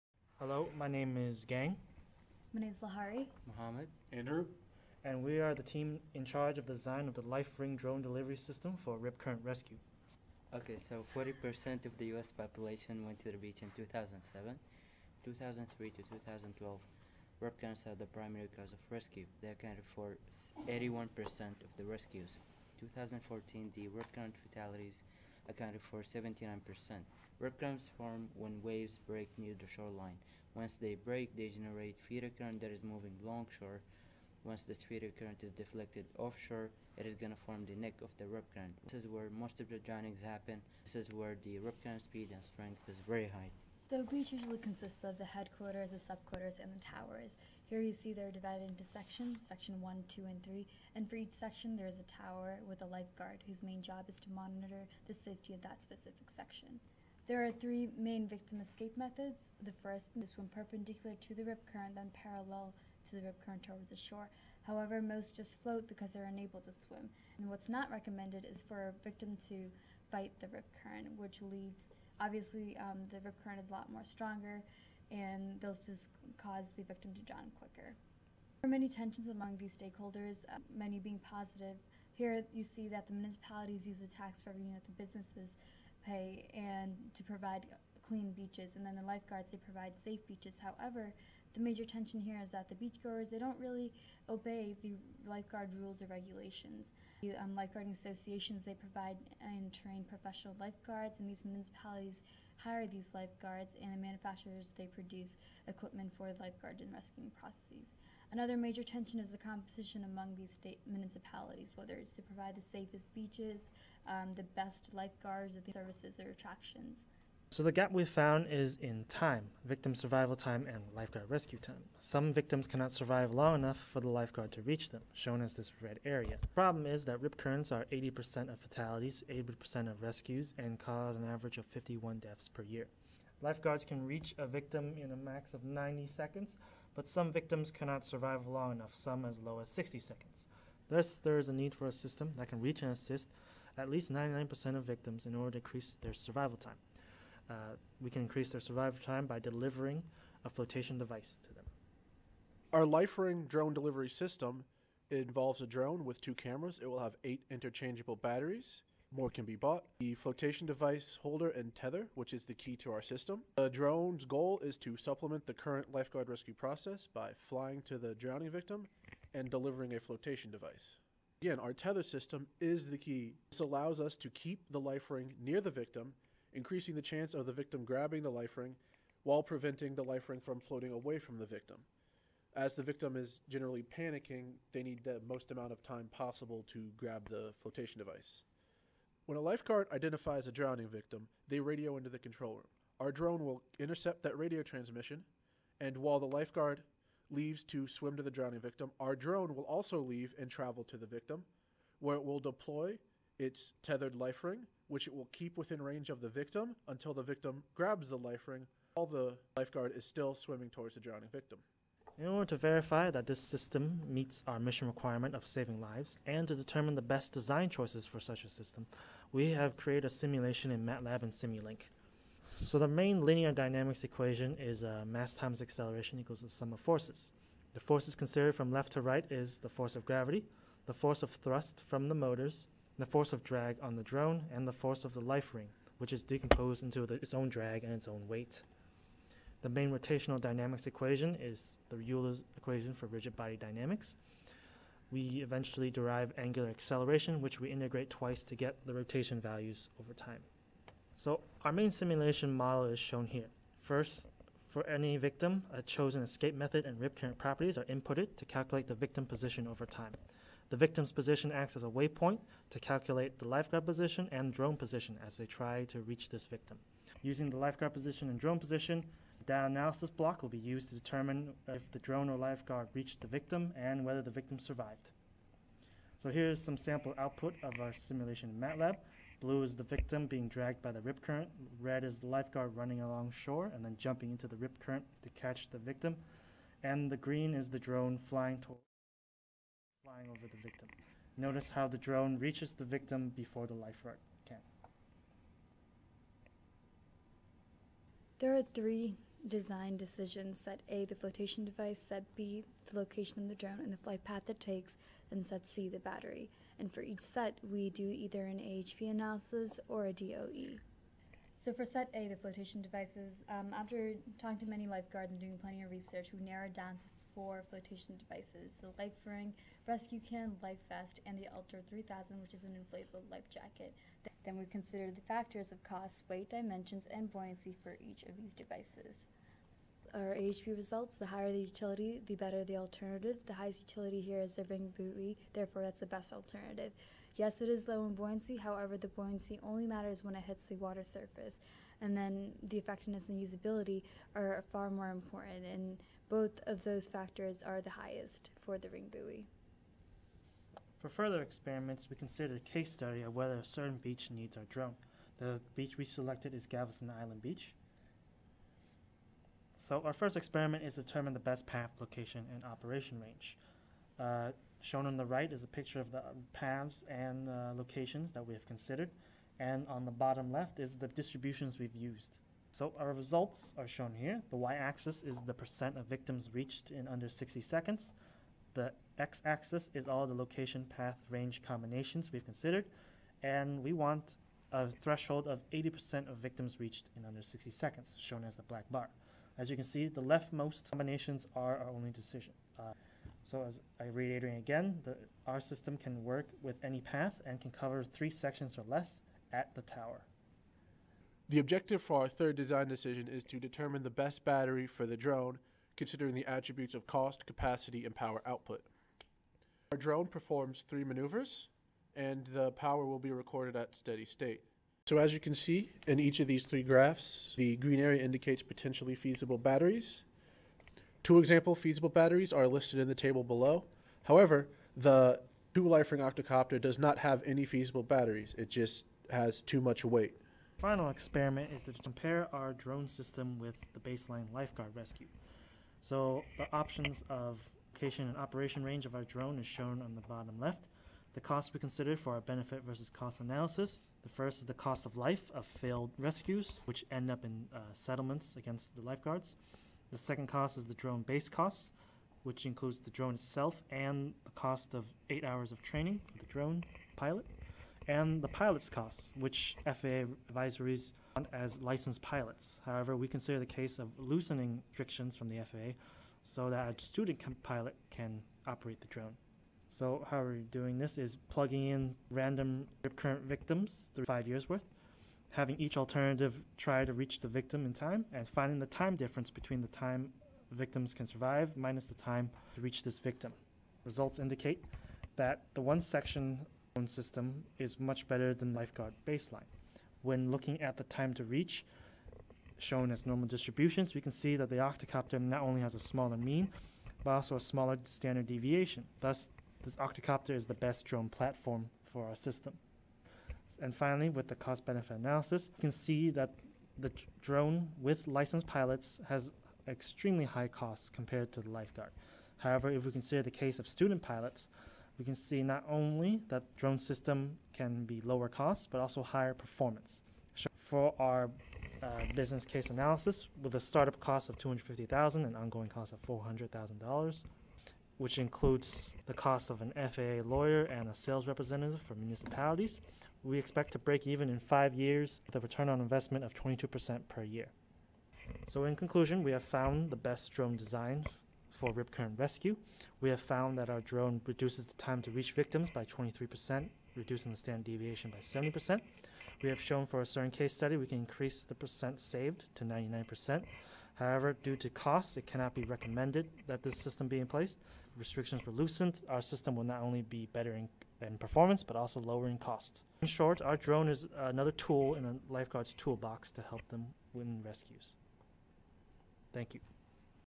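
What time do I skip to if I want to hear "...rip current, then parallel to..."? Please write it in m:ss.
1:01.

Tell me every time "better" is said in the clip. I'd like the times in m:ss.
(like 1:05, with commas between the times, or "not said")
5:32, 8:08, 9:20.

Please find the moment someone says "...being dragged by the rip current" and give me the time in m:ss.
4:40.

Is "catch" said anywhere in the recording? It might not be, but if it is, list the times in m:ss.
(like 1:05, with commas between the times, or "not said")
4:45.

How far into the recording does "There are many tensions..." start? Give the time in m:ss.
1:18.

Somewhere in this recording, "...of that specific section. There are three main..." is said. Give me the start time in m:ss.
0:55.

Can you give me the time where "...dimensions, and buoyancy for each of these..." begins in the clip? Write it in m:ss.
5:26.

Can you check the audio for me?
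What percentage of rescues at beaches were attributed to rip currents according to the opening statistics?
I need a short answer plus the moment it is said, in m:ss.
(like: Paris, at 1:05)
81%, at 0:20.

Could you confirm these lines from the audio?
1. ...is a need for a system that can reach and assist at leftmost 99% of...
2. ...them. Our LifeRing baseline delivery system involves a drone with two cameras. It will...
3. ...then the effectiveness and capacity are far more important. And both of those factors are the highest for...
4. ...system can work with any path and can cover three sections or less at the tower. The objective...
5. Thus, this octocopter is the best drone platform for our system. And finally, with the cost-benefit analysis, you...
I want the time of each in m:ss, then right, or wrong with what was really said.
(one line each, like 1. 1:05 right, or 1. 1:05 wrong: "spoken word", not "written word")
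1. 2:21 wrong: "least", not "leftmost"
2. 2:31 wrong: "drone", not "baseline"
3. 5:42 wrong: "usability", not "capacity"
4. 6:35 right
5. 8:19 right.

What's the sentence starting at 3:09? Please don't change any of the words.
When a lifeguard identifies a drowning victim, they radio into the control room.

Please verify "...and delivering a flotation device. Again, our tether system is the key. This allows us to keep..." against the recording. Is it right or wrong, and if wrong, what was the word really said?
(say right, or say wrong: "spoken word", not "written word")
right.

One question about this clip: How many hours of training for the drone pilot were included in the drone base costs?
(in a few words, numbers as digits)
8.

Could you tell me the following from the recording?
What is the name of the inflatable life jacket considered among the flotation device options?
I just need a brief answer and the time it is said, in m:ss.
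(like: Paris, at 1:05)
Ultra 3000, at 5:21.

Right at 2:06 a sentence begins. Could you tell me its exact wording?
The problem is that rip currents are 80% of fatalities, 80% of rescues, and cause an average of 51 deaths per year.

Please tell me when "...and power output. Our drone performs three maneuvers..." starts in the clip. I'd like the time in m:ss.
6:48.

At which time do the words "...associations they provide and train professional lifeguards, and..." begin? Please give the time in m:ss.
1:37.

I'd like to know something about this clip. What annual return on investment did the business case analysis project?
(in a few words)
22%.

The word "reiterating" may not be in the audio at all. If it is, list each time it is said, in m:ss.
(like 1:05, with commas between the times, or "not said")
6:34.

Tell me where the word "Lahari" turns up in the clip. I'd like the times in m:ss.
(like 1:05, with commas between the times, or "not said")
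0:02.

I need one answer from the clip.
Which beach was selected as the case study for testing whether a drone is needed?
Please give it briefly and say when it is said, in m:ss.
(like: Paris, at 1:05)
Galveston Island Beach, at 5:56.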